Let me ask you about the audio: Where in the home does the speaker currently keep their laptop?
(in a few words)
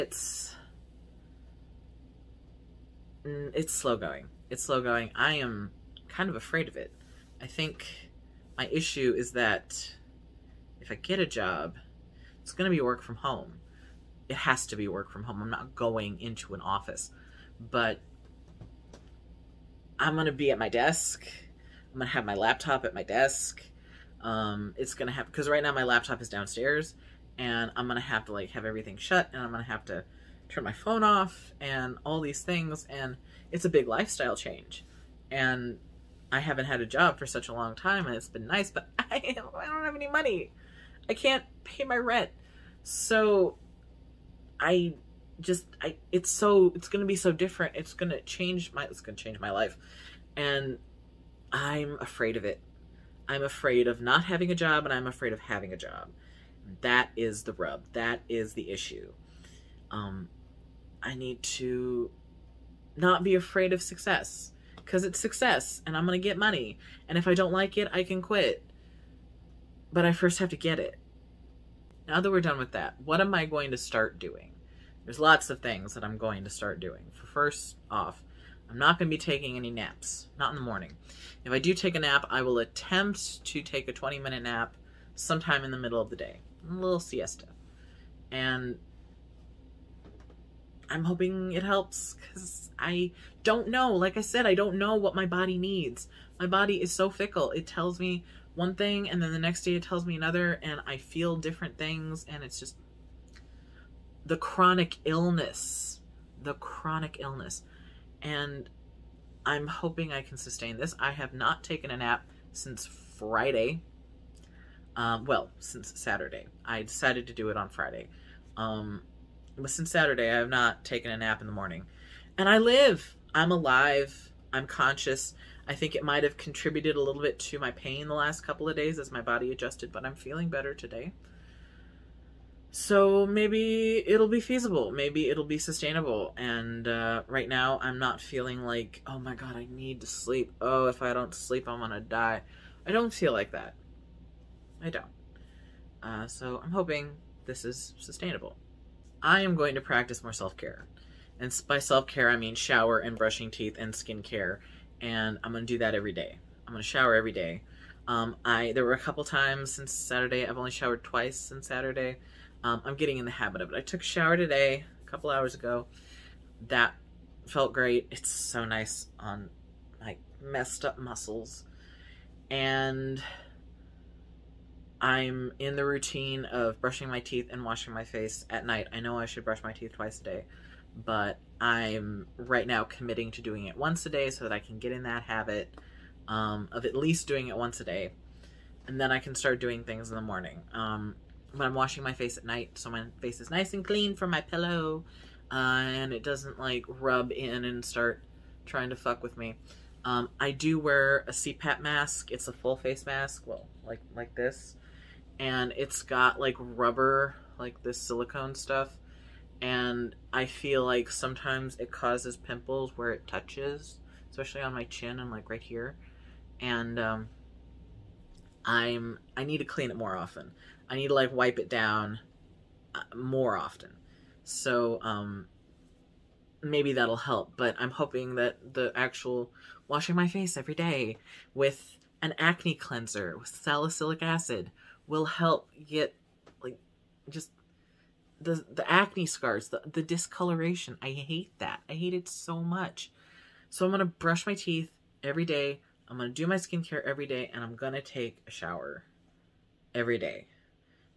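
downstairs.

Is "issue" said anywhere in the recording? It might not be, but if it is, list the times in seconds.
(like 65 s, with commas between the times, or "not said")
8 s, 58 s.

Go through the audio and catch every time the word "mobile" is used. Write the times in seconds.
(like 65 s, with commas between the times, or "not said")
not said.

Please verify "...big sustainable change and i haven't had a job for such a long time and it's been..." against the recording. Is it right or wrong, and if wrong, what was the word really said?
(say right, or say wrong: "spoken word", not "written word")
wrong: "lifestyle", not "sustainable".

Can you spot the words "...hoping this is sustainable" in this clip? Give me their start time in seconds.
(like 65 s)
146 s.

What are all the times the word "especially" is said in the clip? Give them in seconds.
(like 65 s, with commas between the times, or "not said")
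214 s.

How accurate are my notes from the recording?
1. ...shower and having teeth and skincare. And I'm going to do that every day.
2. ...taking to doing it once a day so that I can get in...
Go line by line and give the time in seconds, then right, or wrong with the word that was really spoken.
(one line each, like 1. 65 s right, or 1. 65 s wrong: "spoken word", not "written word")
1. 152 s wrong: "brushing", not "having"
2. 182 s wrong: "committing", not "taking".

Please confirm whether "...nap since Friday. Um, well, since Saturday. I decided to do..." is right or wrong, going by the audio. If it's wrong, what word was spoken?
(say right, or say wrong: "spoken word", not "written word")
right.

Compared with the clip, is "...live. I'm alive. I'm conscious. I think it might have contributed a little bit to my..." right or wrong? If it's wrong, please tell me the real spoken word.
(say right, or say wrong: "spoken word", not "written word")
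right.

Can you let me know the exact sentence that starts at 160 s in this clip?
I've only showered twice since Saturday.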